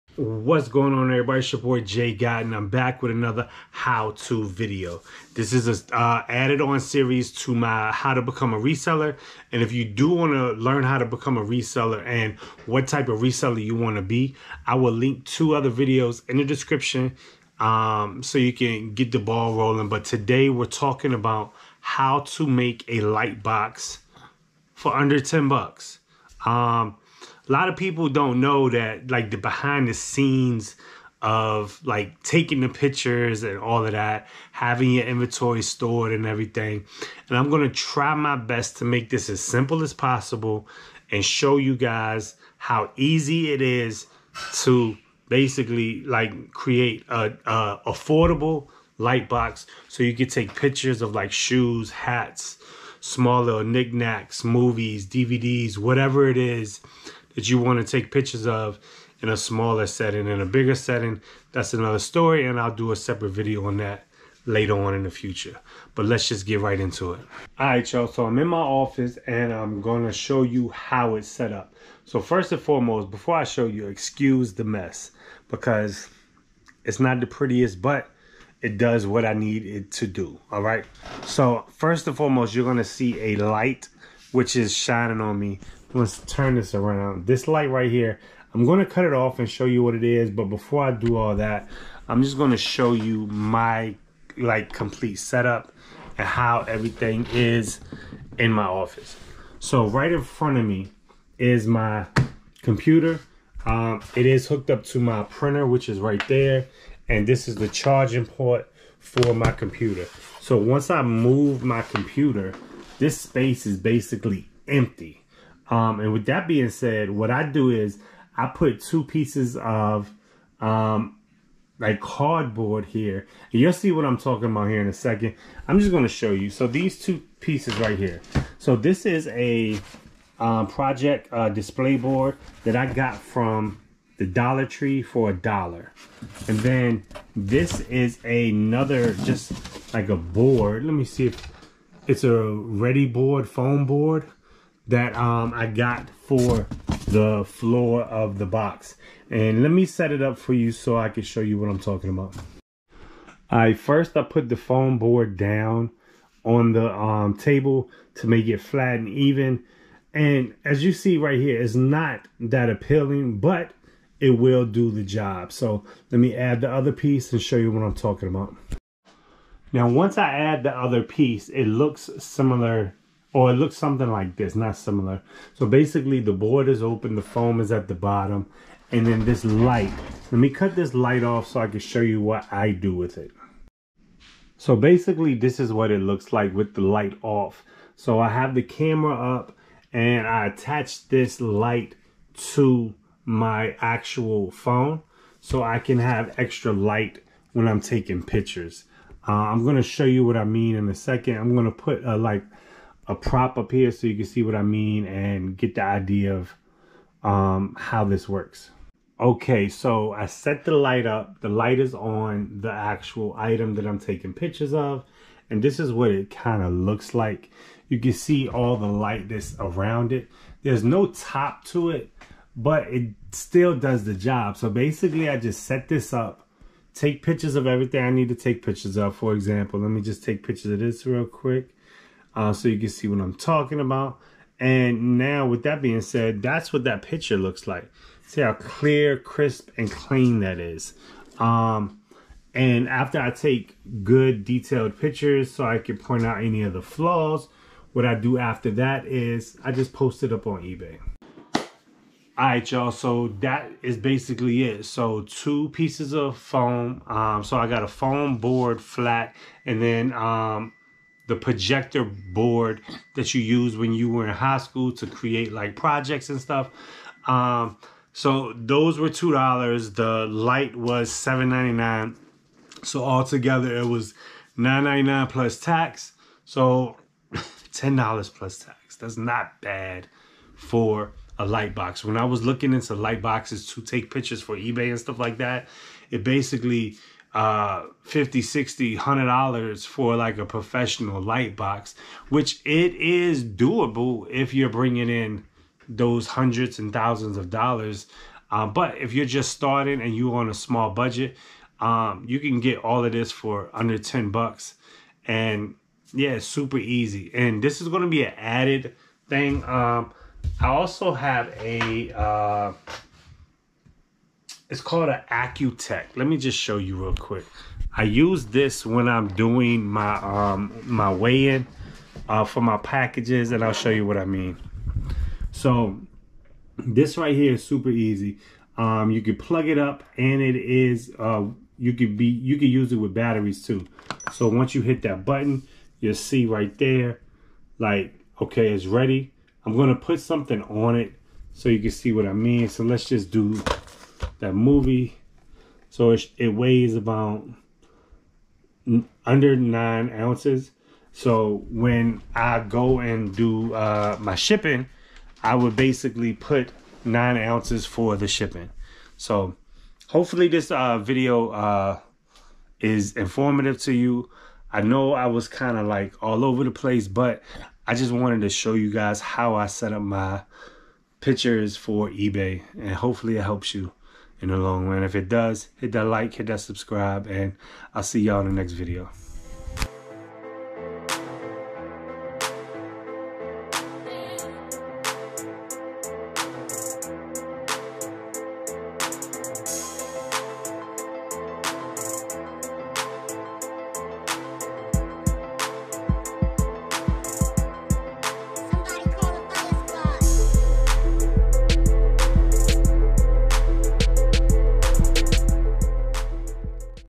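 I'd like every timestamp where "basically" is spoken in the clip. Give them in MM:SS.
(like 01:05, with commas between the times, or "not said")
00:45, 01:53, 02:55, 03:04, 03:44, 04:13, 04:46, 05:55.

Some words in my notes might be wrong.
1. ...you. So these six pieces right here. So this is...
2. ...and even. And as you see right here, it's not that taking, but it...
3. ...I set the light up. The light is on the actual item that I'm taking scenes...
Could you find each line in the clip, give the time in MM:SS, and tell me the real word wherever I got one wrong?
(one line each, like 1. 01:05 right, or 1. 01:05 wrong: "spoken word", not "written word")
1. 02:06 wrong: "two", not "six"
2. 02:38 wrong: "appealing", not "taking"
3. 03:30 wrong: "pictures", not "scenes".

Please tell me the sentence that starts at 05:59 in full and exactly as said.
So hopefully this uh, video uh, is informative to you.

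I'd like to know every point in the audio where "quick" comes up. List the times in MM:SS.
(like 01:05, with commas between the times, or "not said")
03:51, 05:17.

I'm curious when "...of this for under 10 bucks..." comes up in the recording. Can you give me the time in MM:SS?
05:03.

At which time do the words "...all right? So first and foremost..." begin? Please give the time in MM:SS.
01:20.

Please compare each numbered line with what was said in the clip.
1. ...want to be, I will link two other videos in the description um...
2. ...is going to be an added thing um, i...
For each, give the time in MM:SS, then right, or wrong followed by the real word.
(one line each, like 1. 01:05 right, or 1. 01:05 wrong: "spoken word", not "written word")
1. 00:13 right
2. 05:07 right.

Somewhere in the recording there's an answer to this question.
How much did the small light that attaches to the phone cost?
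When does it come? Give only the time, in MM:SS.
04:31.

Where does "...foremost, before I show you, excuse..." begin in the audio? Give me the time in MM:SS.
01:12.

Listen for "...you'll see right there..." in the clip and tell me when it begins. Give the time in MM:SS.
05:35.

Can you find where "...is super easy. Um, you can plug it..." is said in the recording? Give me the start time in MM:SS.
05:27.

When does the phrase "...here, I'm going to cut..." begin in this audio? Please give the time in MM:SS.
01:27.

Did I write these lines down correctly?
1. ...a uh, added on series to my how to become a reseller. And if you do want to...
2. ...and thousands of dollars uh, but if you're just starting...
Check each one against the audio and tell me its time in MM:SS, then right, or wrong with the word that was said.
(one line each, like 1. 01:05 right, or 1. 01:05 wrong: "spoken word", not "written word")
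1. 00:05 right
2. 04:56 right.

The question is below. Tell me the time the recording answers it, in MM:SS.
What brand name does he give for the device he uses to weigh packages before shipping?
05:15.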